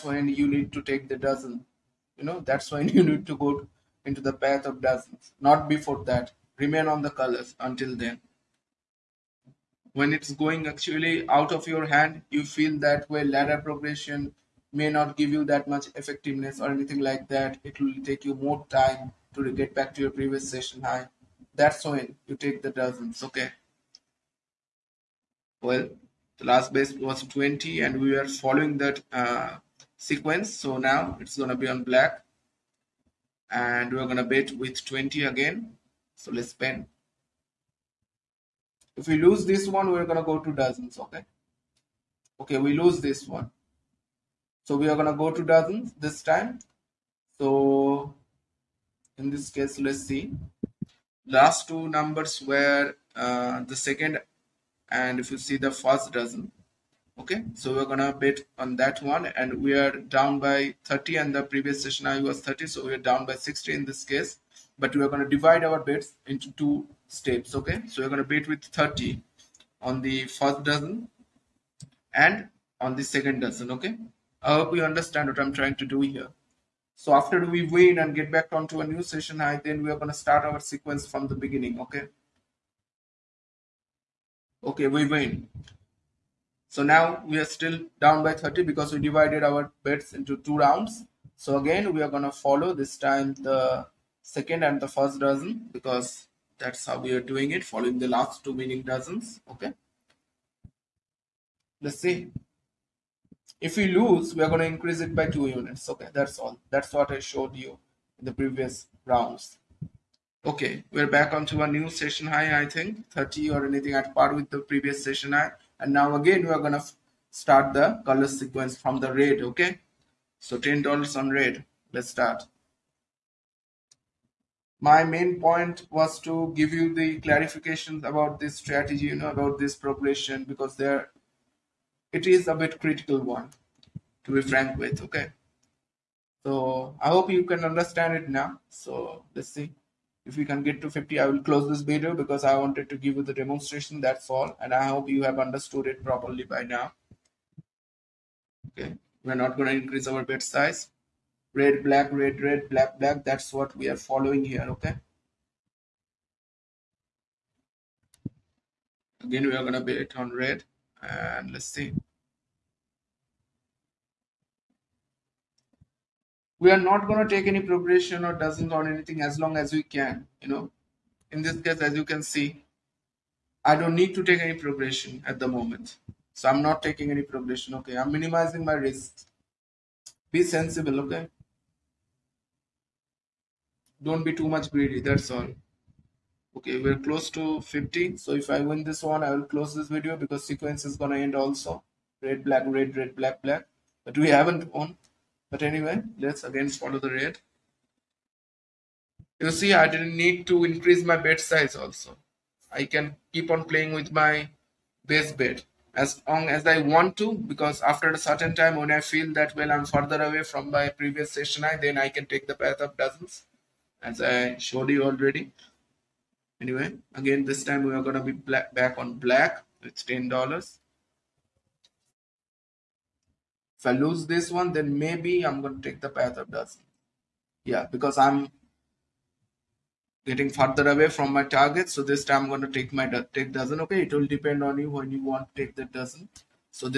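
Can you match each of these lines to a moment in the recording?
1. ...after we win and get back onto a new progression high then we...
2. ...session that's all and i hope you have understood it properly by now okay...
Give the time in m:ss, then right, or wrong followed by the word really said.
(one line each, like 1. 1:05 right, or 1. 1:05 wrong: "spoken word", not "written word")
1. 1:17 wrong: "session", not "progression"
2. 2:23 wrong: "demonstration", not "session".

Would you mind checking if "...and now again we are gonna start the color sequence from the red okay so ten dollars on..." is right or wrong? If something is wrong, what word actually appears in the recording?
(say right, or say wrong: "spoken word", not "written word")
right.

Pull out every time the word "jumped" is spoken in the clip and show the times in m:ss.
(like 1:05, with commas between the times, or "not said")
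not said.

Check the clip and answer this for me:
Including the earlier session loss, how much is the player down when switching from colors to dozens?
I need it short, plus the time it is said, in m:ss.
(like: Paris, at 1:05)
60, at 1:02.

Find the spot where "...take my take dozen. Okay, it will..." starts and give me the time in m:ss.
3:52.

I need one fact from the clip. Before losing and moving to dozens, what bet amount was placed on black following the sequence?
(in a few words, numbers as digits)
20.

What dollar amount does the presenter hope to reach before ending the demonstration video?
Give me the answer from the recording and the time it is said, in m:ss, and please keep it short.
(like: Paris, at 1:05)
50, at 2:20.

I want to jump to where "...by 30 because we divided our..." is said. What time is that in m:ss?
1:28.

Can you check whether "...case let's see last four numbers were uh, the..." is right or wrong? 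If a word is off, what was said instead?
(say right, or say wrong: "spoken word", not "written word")
wrong: "two", not "four".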